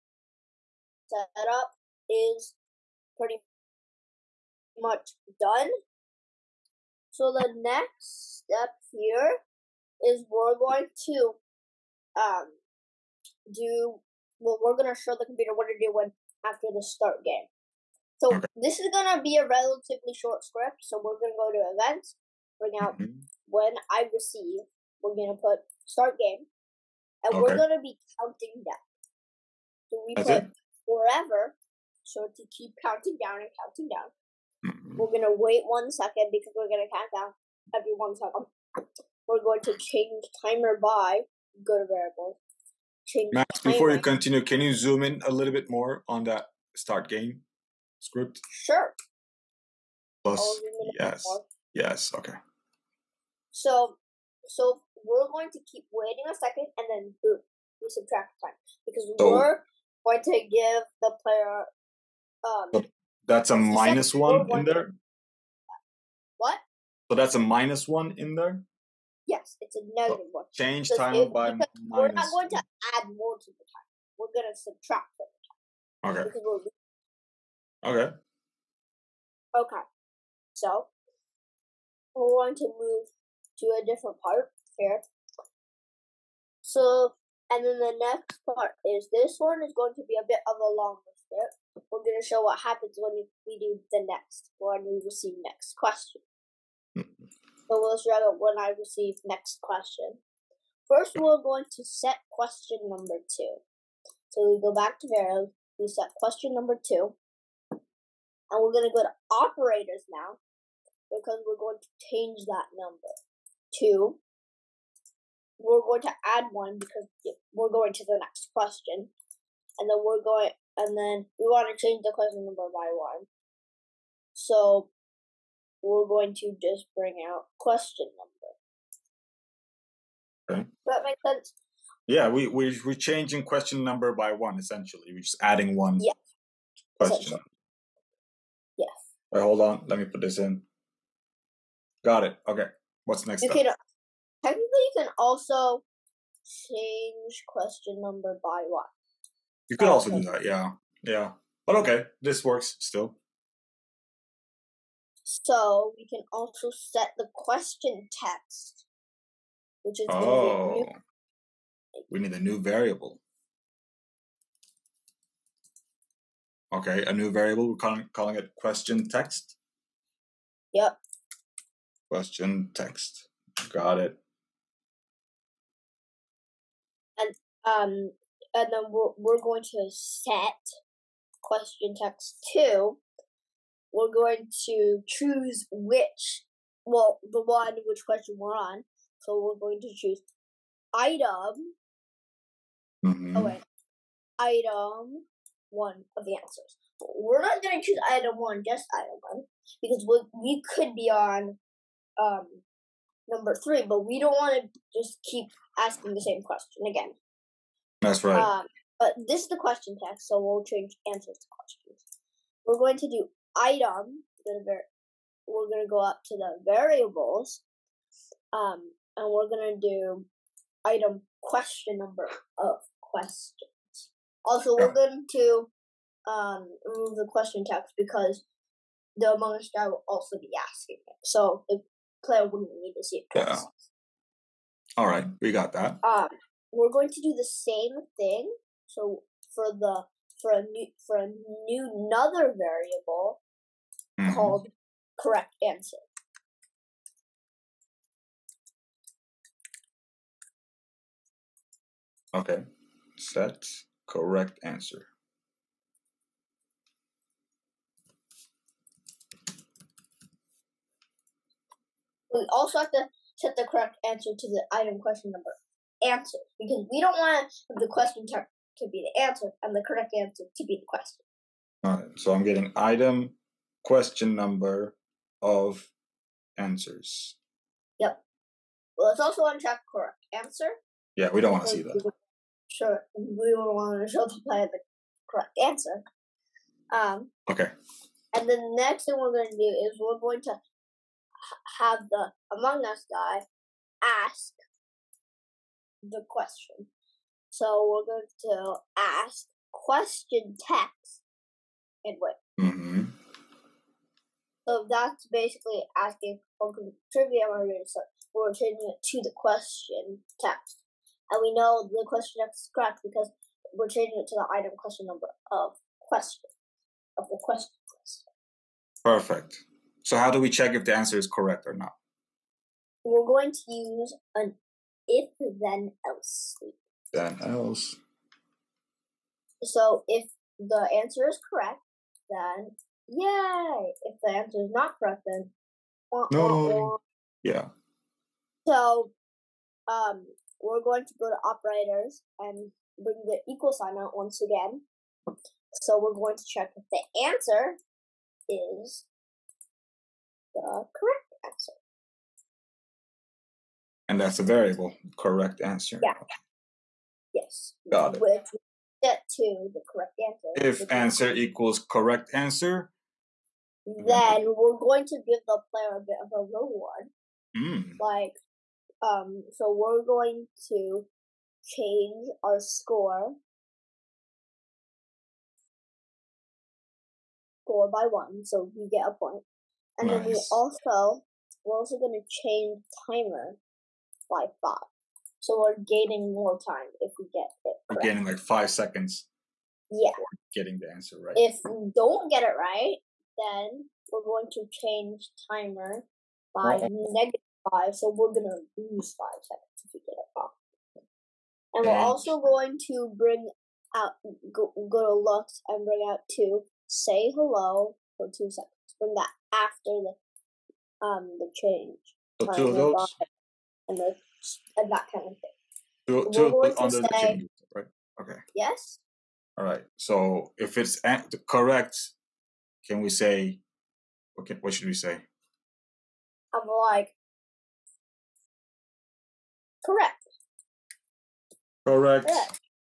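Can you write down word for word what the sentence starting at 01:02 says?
Um, that's a minus one in there.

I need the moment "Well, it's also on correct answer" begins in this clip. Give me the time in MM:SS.
04:38.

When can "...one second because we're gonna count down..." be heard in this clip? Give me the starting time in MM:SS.
00:35.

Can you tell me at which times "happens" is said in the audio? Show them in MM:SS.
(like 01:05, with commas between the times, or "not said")
01:32.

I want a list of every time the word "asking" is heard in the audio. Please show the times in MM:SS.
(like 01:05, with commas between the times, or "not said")
03:25, 03:50, 05:05.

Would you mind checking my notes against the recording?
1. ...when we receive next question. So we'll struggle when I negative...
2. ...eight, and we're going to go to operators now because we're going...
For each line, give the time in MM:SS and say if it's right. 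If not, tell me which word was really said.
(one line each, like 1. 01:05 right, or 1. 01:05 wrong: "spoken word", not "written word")
1. 01:34 wrong: "receive", not "negative"
2. 01:46 wrong: "two", not "eight".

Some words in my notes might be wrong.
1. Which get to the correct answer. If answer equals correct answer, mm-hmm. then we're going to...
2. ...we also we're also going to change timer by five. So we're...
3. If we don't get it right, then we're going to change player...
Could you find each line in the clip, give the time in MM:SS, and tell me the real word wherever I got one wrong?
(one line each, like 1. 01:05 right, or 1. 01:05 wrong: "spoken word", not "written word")
1. 05:58 right
2. 06:20 right
3. 06:31 wrong: "timer", not "player".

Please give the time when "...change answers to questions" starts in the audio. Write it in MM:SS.
03:30.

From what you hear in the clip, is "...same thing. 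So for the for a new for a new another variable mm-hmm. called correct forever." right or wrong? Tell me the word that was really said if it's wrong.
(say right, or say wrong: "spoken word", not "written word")
wrong: "answer", not "forever".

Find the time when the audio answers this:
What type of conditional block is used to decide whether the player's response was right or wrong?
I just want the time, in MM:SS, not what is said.
05:25.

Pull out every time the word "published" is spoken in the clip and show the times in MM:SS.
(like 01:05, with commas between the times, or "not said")
not said.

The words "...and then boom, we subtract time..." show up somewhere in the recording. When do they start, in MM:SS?
00:56.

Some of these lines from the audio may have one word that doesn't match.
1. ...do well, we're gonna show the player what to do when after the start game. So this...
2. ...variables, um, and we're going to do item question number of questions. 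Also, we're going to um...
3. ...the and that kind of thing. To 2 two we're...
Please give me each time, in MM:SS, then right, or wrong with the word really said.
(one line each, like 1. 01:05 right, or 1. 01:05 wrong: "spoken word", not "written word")
1. 00:13 wrong: "computer", not "player"
2. 03:36 right
3. 06:53 right.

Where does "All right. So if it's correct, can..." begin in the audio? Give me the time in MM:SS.
06:59.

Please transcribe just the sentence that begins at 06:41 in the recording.
And we're and also going to bring out, go, go to Looks and bring out to say hello for two seconds.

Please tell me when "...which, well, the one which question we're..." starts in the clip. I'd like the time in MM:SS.
03:05.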